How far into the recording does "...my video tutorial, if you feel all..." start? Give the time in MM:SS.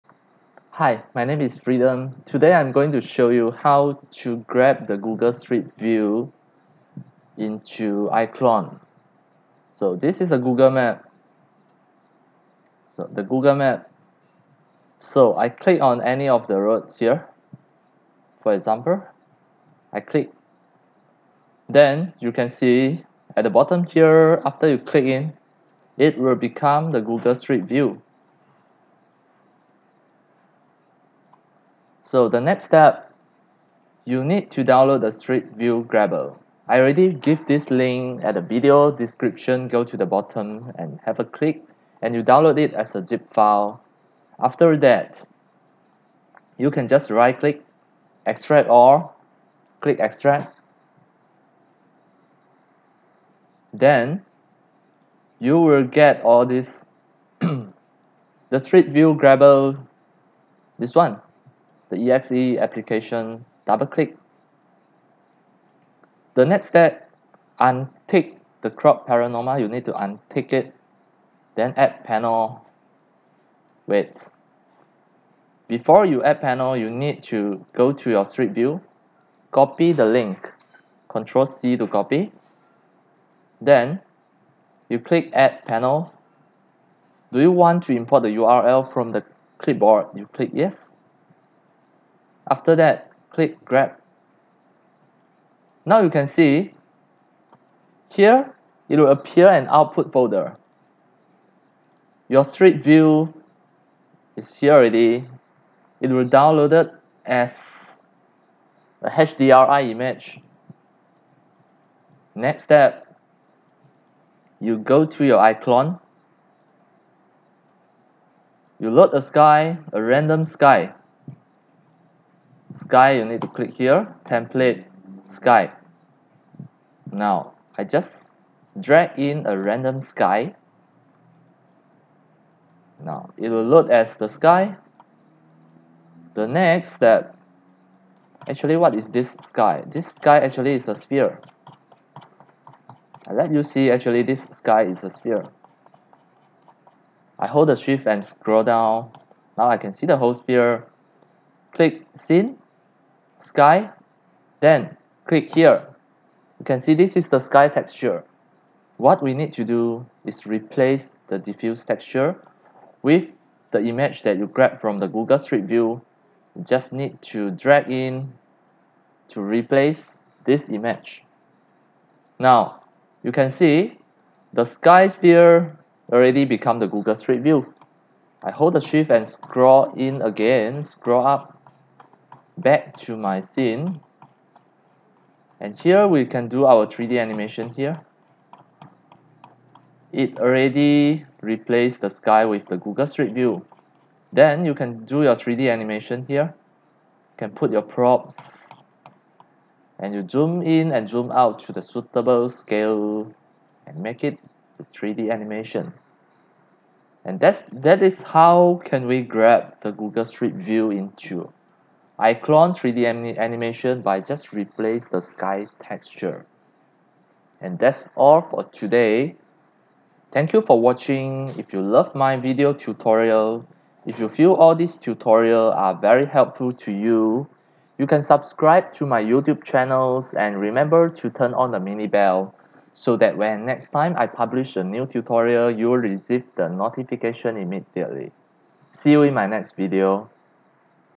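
03:42.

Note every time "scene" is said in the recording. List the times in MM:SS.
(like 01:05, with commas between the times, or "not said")
02:32, 03:03.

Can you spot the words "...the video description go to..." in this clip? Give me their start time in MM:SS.
00:38.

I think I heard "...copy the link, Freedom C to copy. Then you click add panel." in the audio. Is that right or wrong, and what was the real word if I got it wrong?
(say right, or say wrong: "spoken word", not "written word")
wrong: "Control", not "Freedom".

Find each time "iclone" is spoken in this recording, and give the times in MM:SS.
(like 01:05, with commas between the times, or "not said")
00:08, 01:55, 03:32.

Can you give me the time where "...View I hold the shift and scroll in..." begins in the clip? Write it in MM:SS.
02:57.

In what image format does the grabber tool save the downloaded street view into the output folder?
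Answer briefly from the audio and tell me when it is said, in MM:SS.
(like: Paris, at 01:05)
HDRI image, at 01:49.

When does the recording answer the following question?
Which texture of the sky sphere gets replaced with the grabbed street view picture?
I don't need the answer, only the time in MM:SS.
02:41.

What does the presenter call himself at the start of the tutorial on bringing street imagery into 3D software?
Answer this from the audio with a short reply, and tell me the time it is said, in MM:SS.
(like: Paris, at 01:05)
Freedom, at 00:01.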